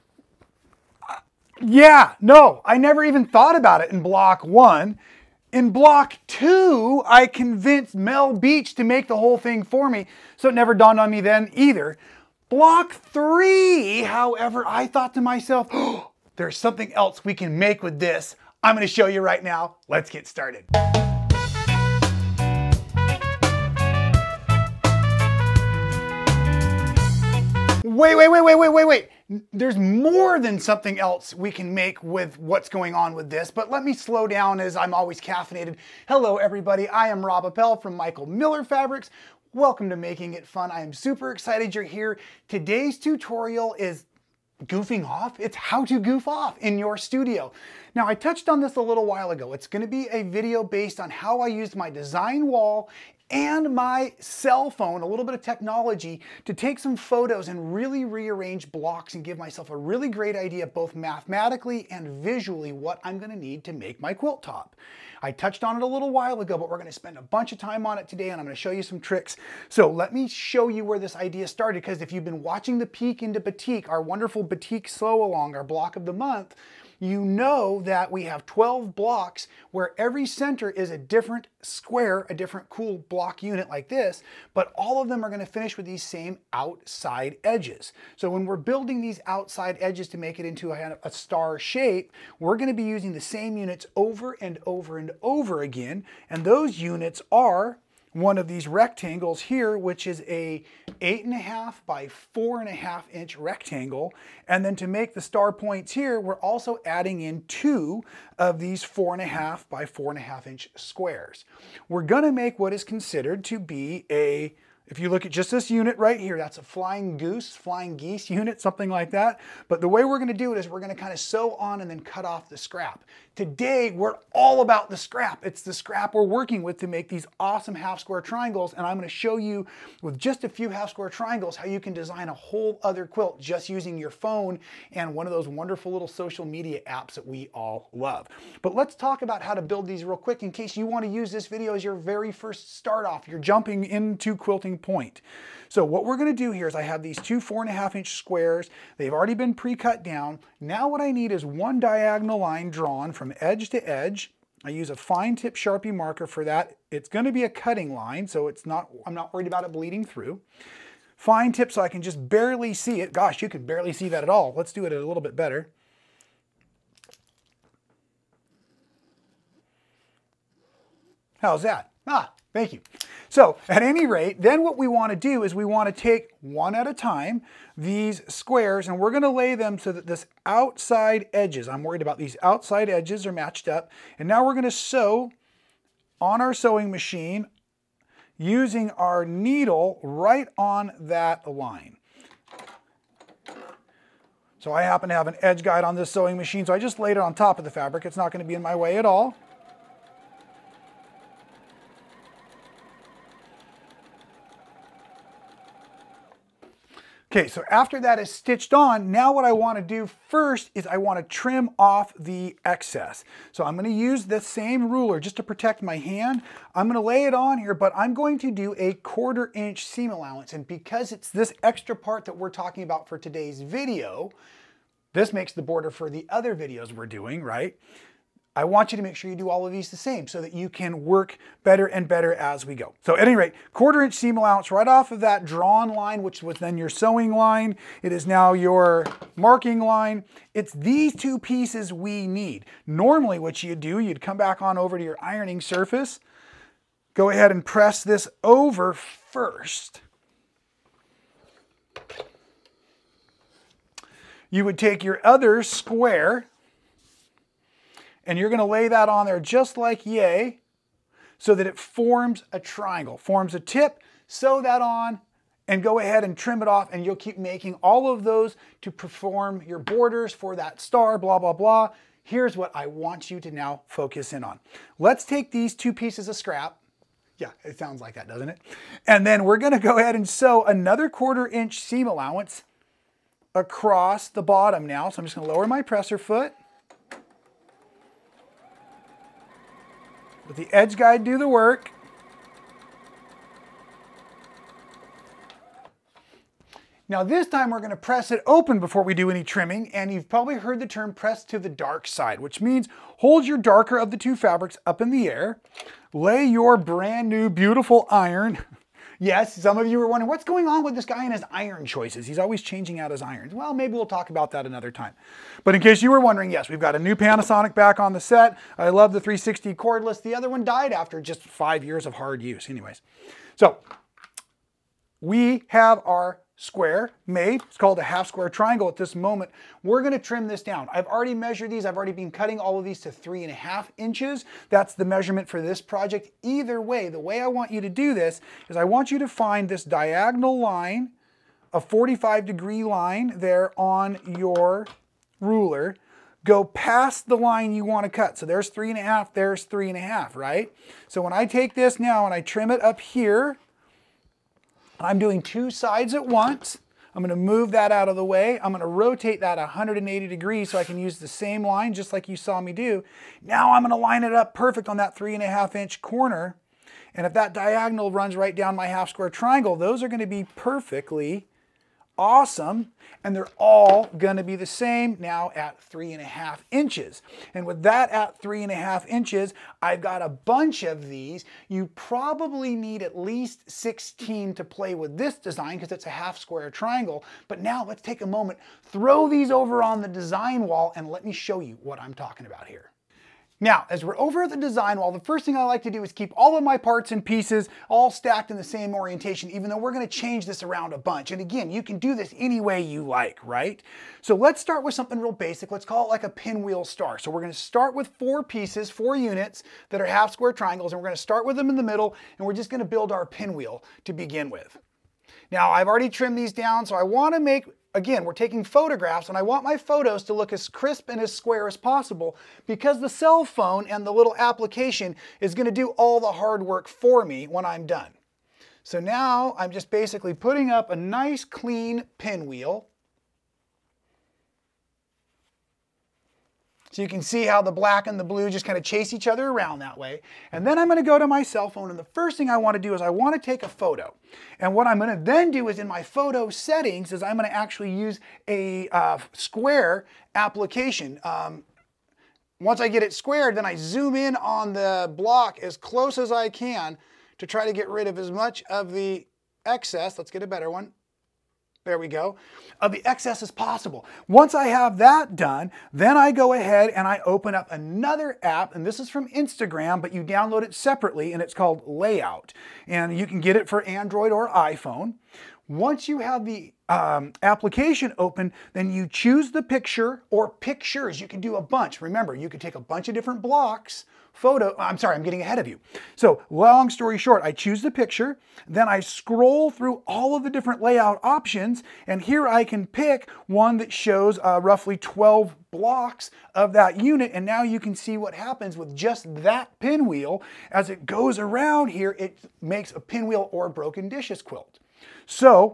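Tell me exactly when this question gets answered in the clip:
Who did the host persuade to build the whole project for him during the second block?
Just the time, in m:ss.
0:07.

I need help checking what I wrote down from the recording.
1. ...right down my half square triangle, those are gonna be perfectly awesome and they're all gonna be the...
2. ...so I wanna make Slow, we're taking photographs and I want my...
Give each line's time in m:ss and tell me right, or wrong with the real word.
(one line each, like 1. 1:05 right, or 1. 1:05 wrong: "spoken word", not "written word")
1. 6:08 right
2. 6:56 wrong: "Again", not "Slow".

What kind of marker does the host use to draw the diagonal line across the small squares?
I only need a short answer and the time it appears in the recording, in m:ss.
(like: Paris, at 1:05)
Fine tip Sharpie, at 2:34.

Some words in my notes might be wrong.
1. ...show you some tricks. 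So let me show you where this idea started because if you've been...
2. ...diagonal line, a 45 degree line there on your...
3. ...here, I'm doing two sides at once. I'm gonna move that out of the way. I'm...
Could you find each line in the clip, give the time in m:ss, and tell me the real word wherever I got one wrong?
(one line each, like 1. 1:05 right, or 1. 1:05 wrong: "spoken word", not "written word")
1. 1:08 right
2. 5:39 right
3. 5:52 right.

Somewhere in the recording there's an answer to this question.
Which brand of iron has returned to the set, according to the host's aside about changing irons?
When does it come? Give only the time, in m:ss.
5:17.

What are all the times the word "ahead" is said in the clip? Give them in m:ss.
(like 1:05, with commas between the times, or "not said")
4:07, 4:25, 4:39, 7:46, 8:05.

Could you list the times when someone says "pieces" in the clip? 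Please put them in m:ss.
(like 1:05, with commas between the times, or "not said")
4:01, 4:35, 6:37, 6:48.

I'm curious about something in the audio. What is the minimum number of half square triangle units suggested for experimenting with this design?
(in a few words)
16.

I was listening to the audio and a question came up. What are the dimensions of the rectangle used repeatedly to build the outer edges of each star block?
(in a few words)
8.5 by 4.5 inches.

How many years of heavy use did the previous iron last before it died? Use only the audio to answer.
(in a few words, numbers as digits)
5.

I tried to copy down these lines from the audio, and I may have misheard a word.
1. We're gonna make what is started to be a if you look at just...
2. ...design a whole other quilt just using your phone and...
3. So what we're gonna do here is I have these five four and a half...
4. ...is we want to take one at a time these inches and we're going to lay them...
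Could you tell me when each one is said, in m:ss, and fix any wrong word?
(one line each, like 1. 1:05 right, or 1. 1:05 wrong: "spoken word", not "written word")
1. 1:51 wrong: "considered", not "started"
2. 2:11 right
3. 2:25 wrong: "two", not "five"
4. 2:55 wrong: "squares", not "inches".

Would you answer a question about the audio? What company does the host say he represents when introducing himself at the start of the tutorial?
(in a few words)
Michael Miller Fabrics.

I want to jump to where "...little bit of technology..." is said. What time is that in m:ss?
0:55.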